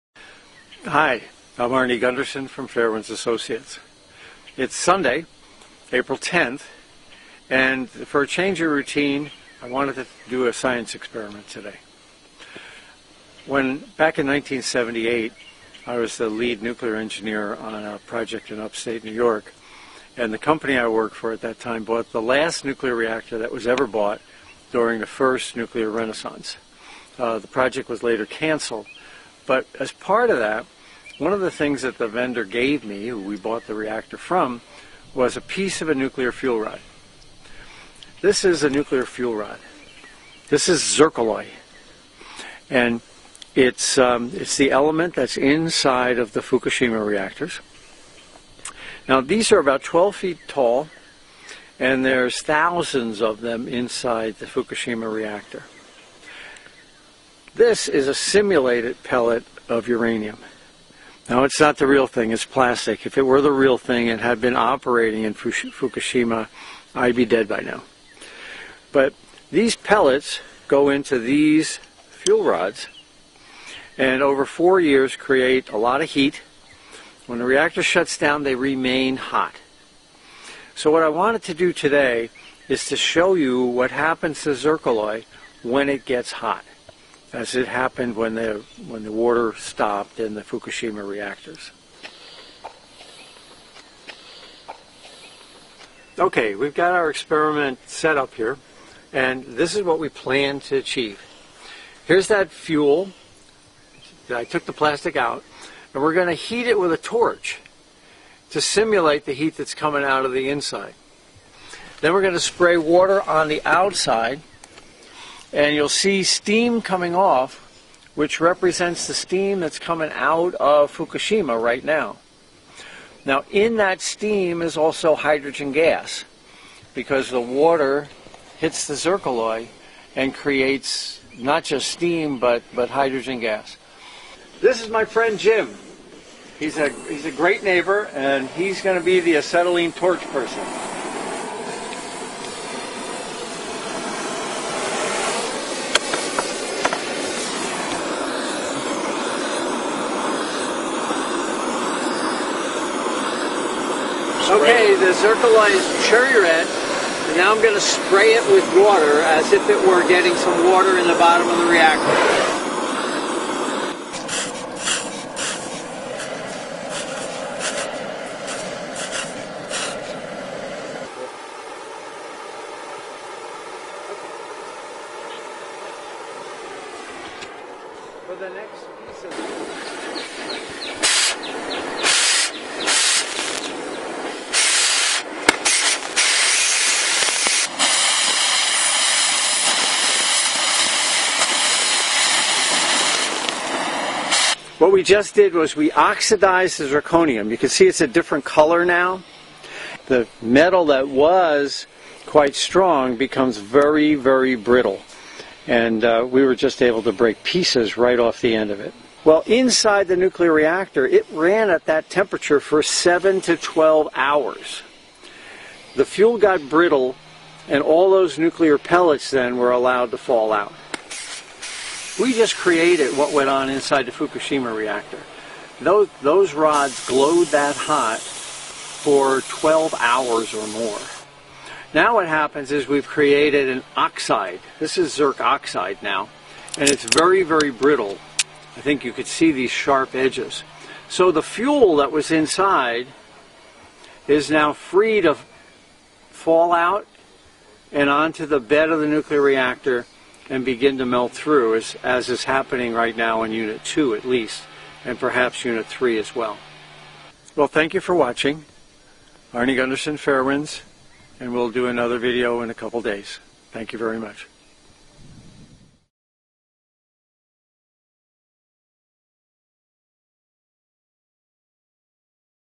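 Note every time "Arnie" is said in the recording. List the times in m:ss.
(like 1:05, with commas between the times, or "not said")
0:01, 4:19.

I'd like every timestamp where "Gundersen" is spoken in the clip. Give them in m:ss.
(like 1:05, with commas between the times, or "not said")
0:02, 4:19.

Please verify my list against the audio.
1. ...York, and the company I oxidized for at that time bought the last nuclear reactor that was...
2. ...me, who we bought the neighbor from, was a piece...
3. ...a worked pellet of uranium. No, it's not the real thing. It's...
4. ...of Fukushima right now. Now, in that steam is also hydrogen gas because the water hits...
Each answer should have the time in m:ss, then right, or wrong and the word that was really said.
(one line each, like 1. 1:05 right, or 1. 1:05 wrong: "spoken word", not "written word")
1. 0:19 wrong: "worked", not "oxidized"
2. 0:32 wrong: "reactor", not "neighbor"
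3. 0:58 wrong: "simulated", not "worked"
4. 2:00 right.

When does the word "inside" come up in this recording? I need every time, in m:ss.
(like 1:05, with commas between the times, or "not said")
0:45, 0:53, 1:50, 3:29, 3:43, 4:02.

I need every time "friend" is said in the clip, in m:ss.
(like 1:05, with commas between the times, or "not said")
2:15.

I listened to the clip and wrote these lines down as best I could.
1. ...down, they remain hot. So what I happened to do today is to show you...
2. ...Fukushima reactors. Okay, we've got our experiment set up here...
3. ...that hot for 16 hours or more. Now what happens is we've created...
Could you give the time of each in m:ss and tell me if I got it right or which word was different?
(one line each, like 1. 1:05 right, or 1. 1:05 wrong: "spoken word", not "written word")
1. 1:18 wrong: "wanted", not "happened"
2. 1:30 right
3. 3:47 wrong: "12", not "16".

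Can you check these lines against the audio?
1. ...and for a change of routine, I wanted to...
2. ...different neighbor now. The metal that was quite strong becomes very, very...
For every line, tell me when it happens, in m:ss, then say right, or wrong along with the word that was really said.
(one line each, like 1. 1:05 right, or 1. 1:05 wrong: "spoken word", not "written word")
1. 0:07 right
2. 3:18 wrong: "color", not "neighbor".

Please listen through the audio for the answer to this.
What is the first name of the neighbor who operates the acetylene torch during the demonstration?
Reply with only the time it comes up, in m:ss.
2:15.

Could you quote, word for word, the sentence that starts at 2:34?
Okay, the zircaloy is cherry red.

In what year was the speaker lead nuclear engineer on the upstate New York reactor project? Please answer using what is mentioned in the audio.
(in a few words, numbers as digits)
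1978.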